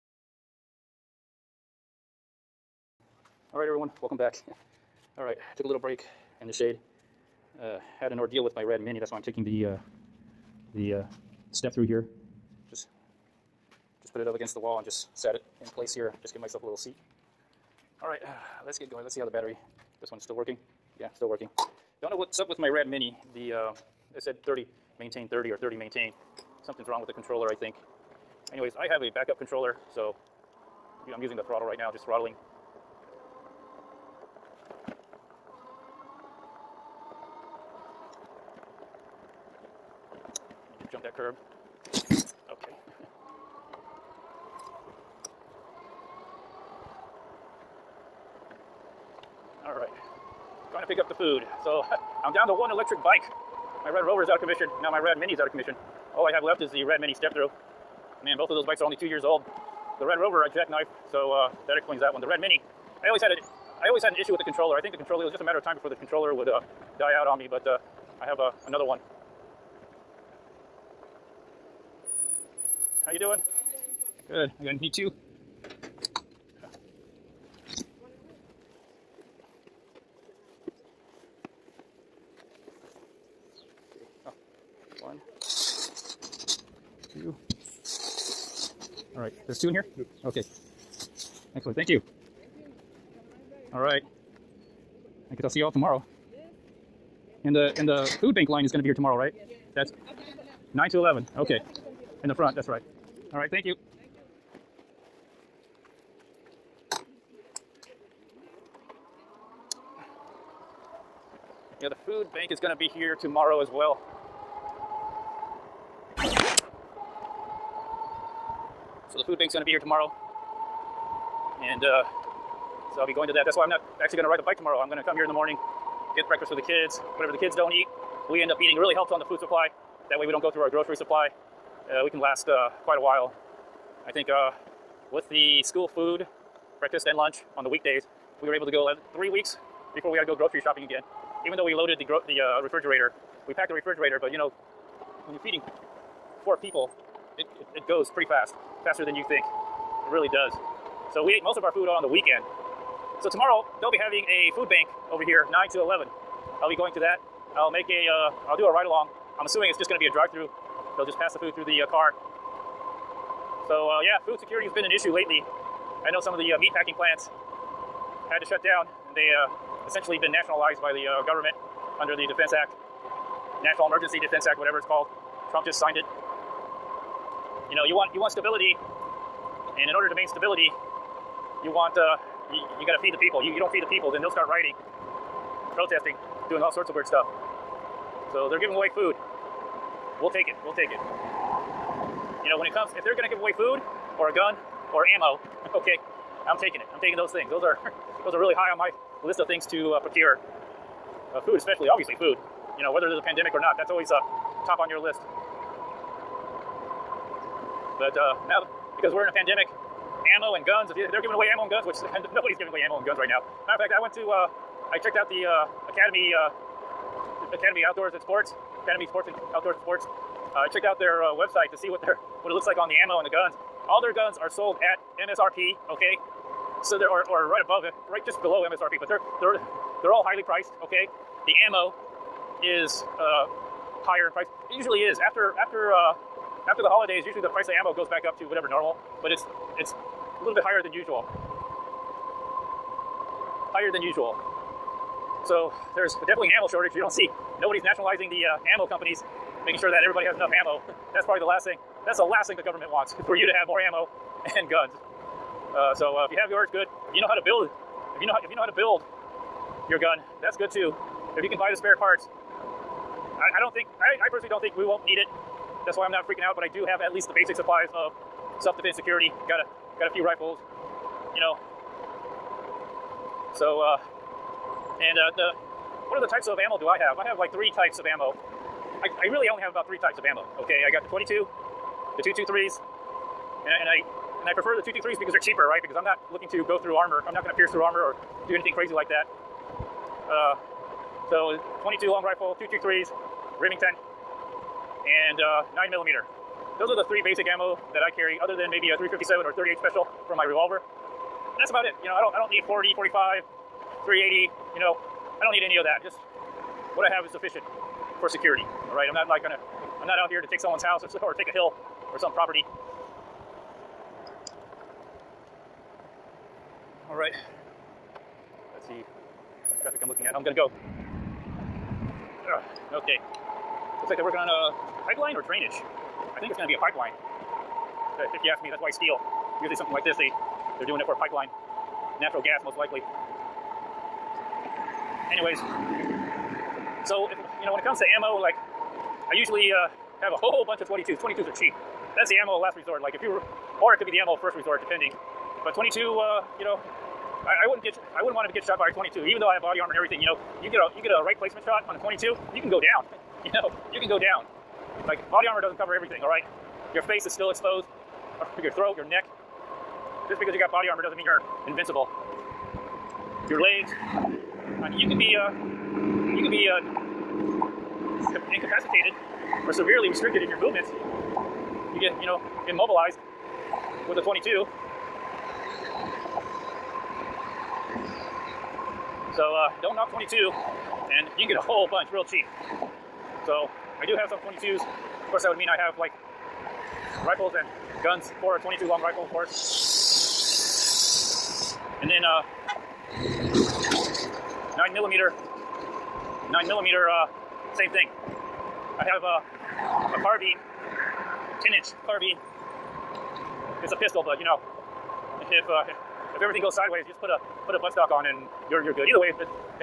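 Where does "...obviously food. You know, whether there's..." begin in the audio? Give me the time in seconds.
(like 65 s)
201 s.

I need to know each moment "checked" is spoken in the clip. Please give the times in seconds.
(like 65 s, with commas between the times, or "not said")
214 s, 220 s.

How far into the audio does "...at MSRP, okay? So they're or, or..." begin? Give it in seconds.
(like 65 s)
224 s.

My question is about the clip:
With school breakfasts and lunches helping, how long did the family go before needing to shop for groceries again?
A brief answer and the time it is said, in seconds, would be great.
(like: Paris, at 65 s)
3 weeks, at 139 s.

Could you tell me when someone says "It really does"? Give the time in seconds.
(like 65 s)
150 s.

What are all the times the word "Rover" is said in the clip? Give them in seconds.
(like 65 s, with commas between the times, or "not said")
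54 s, 60 s.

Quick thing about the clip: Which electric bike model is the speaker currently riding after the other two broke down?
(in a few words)
Rad Mini step through.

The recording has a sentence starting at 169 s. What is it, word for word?
They uh, essentially been nationalized by the uh, government under the Defense Act, National Emergency Defense Act, whatever it's called.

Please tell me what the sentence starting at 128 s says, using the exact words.
We end up eating really helps on the food supply.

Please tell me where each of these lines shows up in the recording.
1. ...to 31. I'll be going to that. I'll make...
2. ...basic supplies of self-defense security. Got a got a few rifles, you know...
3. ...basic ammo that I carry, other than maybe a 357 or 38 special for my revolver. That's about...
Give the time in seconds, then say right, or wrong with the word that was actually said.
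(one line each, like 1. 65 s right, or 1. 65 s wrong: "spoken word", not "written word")
1. 155 s wrong: "11", not "31"
2. 267 s right
3. 297 s right.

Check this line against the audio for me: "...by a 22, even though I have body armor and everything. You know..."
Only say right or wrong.
right.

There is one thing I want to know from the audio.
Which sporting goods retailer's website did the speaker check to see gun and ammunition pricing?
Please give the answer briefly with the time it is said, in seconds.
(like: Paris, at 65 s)
Academy Sports and Outdoors, at 218 s.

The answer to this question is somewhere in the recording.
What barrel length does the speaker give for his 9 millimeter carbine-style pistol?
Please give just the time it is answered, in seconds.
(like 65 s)
401 s.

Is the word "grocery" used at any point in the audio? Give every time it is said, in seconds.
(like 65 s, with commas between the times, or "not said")
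130 s, 140 s.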